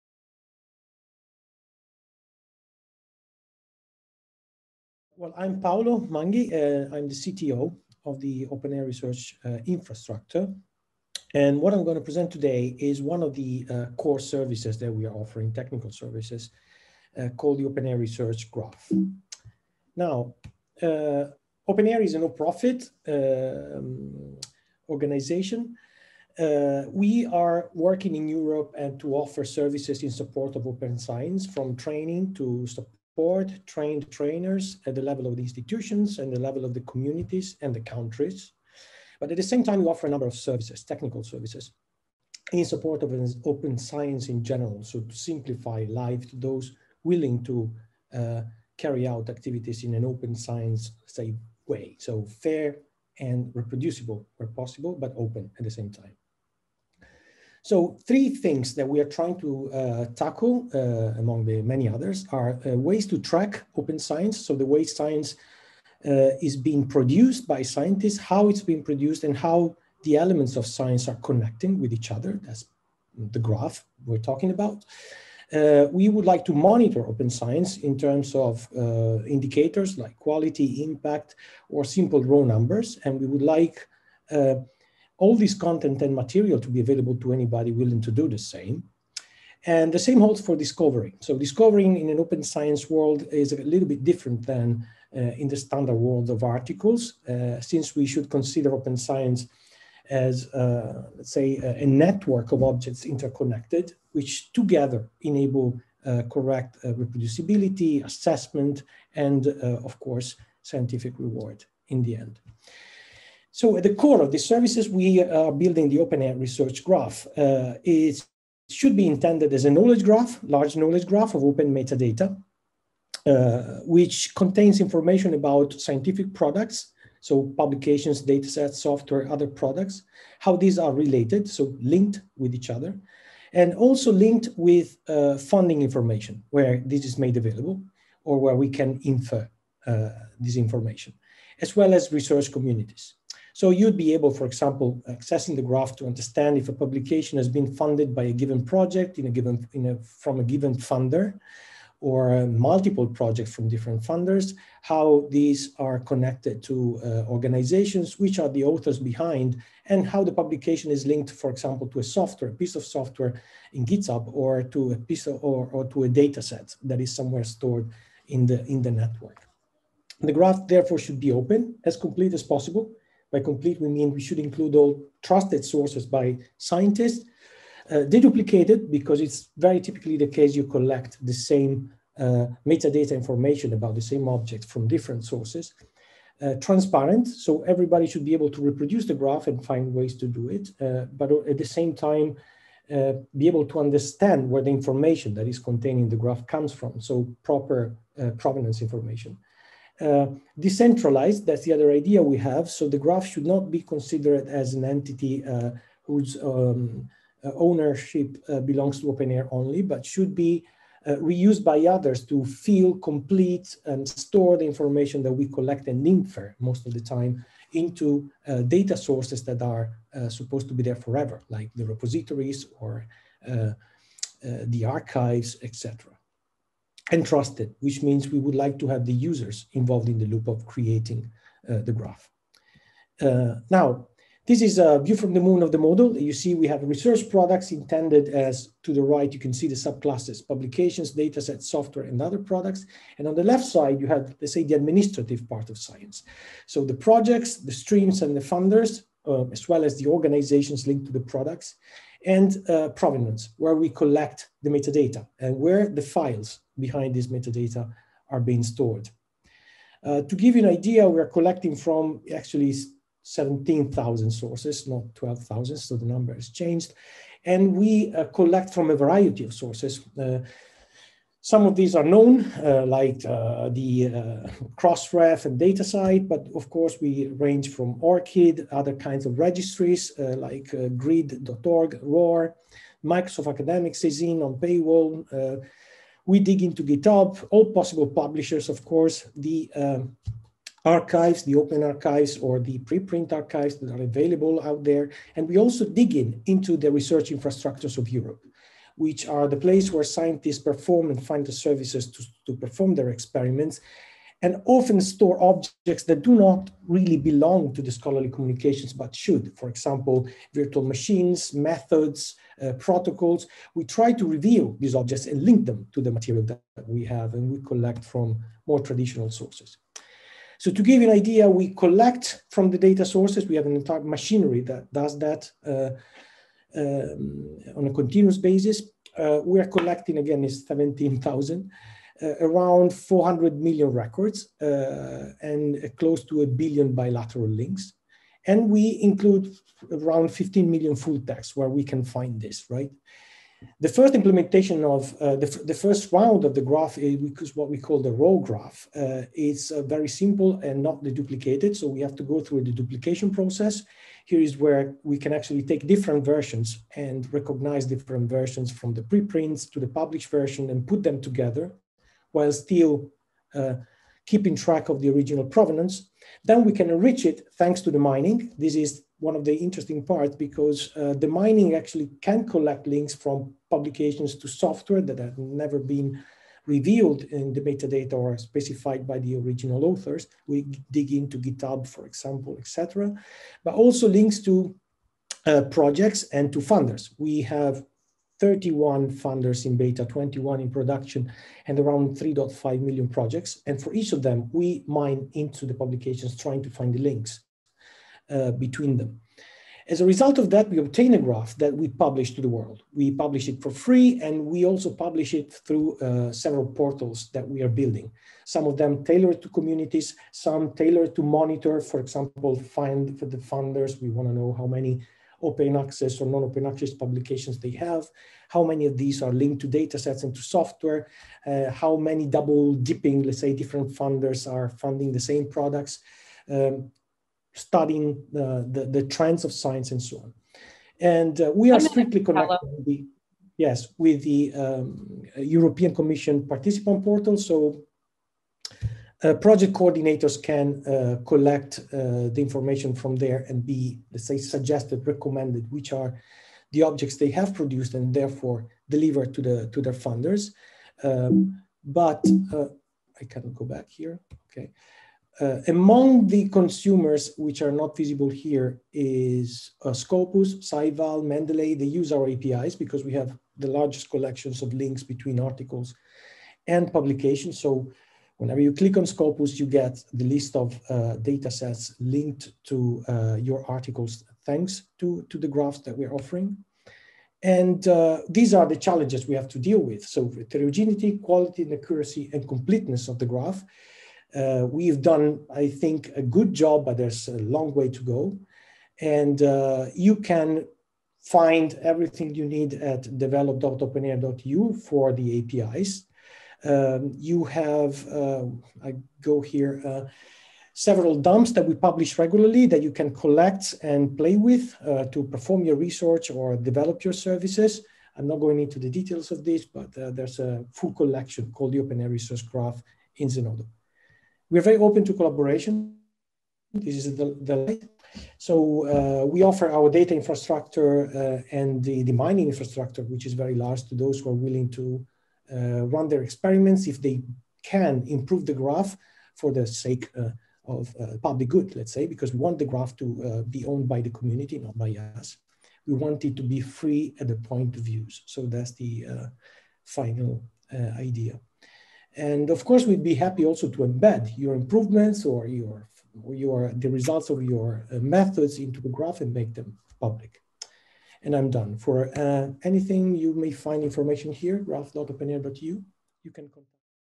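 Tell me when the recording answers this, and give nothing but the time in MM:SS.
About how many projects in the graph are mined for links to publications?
06:32.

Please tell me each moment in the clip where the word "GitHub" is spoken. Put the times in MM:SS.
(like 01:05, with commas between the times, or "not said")
02:43, 04:46, 06:21.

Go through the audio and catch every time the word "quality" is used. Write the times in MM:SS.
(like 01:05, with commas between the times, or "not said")
01:20, 08:01.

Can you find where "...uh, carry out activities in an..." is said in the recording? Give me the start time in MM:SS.
00:48.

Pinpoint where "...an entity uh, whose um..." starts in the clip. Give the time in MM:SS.
03:24.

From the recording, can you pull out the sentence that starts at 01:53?
So at the core of the services we uh, are building the air Research Graph.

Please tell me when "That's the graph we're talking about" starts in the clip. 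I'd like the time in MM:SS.
01:12.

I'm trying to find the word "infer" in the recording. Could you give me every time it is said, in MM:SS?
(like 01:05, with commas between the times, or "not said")
02:19, 03:36.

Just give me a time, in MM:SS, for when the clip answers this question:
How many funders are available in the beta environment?
06:28.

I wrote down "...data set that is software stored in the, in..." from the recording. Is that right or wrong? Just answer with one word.
wrong.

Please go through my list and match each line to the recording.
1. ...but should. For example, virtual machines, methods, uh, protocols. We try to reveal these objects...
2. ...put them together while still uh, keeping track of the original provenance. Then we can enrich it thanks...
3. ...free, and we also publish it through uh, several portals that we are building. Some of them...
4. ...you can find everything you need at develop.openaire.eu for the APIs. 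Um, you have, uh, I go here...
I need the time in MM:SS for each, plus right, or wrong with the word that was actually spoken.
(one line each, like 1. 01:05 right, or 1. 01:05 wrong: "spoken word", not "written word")
1. 05:08 right
2. 06:00 right
3. 06:43 right
4. 08:09 right.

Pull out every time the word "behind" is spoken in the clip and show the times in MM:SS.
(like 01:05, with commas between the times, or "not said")
02:38, 04:16.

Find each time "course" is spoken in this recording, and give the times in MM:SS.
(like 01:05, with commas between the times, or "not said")
01:49, 04:36, 04:48, 09:02.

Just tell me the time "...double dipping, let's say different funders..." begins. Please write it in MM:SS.
07:02.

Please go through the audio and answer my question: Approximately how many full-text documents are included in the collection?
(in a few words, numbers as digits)
15 million.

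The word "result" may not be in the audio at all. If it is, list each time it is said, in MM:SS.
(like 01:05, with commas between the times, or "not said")
06:40, 09:06.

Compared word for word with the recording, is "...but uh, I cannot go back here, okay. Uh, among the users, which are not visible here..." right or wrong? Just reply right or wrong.
wrong.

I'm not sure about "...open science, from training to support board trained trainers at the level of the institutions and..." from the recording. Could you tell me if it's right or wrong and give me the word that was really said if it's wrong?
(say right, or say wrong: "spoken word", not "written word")
right.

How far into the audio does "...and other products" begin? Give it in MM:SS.
04:02.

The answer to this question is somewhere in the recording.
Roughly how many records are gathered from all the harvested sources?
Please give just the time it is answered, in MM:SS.
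05:32.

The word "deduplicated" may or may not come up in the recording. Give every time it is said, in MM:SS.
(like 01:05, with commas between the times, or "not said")
02:58, 05:51.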